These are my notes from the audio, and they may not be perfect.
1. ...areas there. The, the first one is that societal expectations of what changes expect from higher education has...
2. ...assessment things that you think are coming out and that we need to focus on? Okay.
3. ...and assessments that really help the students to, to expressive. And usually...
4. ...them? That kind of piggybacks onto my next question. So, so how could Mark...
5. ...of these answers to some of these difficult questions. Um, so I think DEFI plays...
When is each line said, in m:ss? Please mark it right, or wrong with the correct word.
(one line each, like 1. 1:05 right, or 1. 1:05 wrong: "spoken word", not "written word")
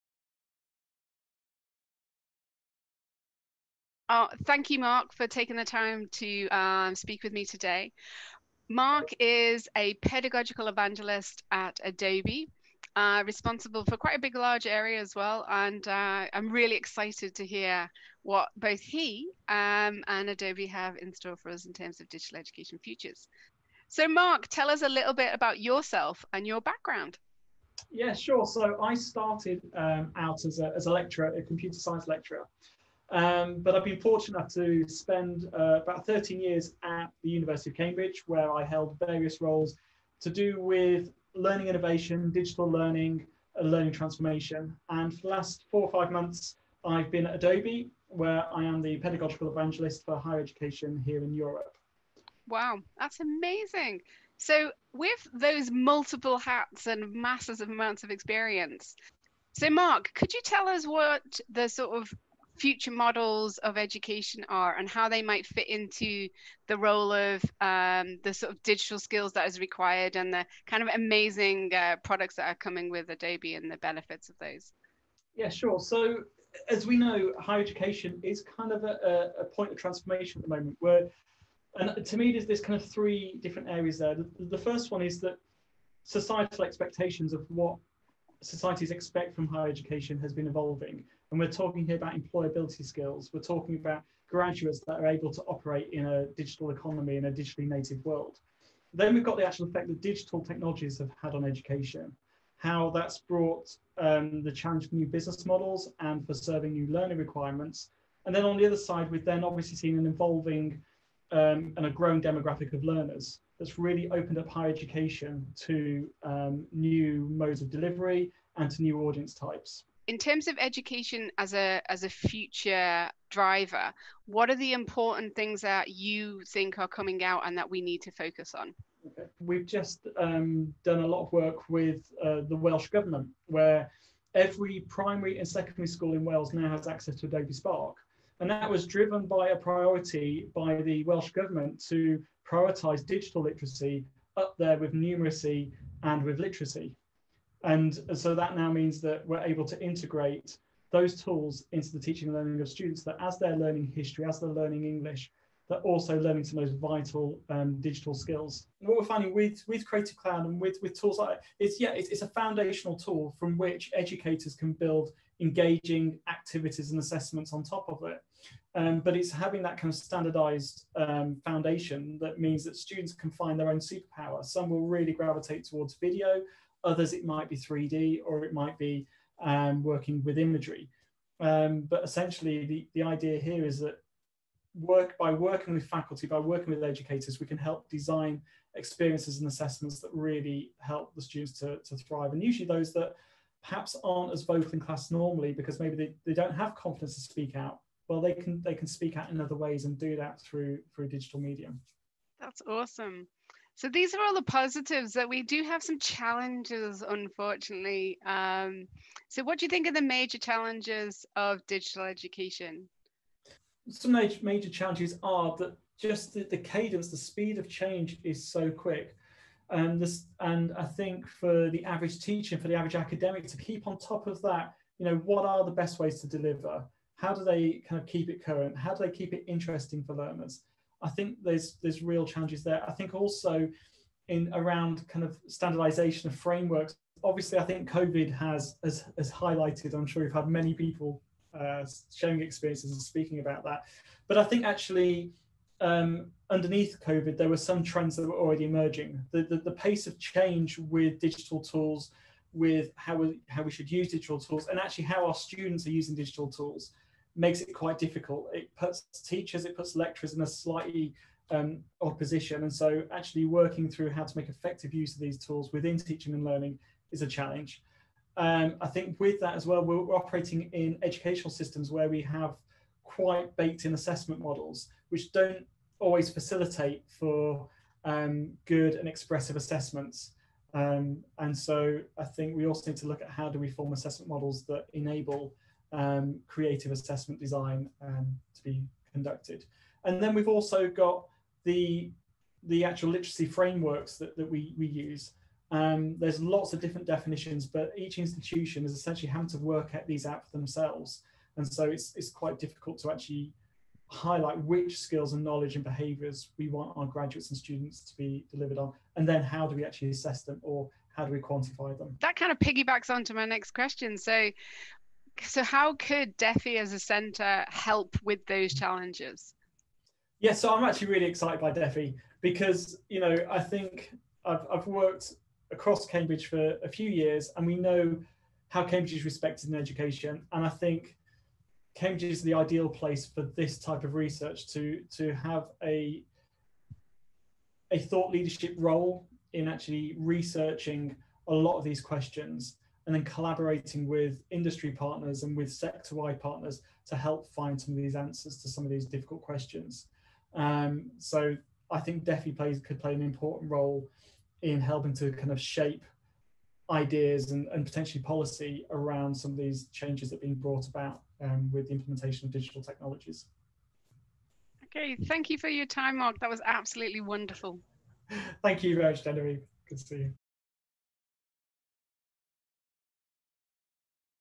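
1. 1:23 wrong: "societies", not "changes"
2. 2:04 wrong: "important", not "assessment"
3. 3:09 wrong: "thrive", not "expressive"
4. 5:11 wrong: "DEFI", not "Mark"
5. 5:47 right.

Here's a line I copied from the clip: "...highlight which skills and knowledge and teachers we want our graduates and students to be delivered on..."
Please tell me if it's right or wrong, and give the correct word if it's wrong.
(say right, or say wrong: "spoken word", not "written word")
wrong: "behaviours", not "teachers".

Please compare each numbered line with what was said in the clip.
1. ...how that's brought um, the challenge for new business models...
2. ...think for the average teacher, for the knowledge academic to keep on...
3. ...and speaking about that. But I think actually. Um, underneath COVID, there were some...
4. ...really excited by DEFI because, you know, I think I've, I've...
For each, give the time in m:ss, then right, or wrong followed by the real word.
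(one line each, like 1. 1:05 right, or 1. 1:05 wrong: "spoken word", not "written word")
1. 1:42 right
2. 3:40 wrong: "average", not "knowledge"
3. 4:02 right
4. 5:21 right.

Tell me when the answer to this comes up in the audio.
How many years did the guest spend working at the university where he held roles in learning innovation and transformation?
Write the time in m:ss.
0:36.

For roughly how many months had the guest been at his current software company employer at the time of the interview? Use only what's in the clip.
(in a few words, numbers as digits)
four or five months.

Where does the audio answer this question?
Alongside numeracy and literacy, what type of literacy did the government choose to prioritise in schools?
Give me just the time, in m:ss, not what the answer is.
2:23.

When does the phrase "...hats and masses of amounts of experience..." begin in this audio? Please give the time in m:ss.
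0:56.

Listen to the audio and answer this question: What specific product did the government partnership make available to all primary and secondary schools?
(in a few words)
Adobe Spark.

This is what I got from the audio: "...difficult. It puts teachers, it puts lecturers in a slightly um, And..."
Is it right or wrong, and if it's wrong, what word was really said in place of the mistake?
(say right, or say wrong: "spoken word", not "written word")
right.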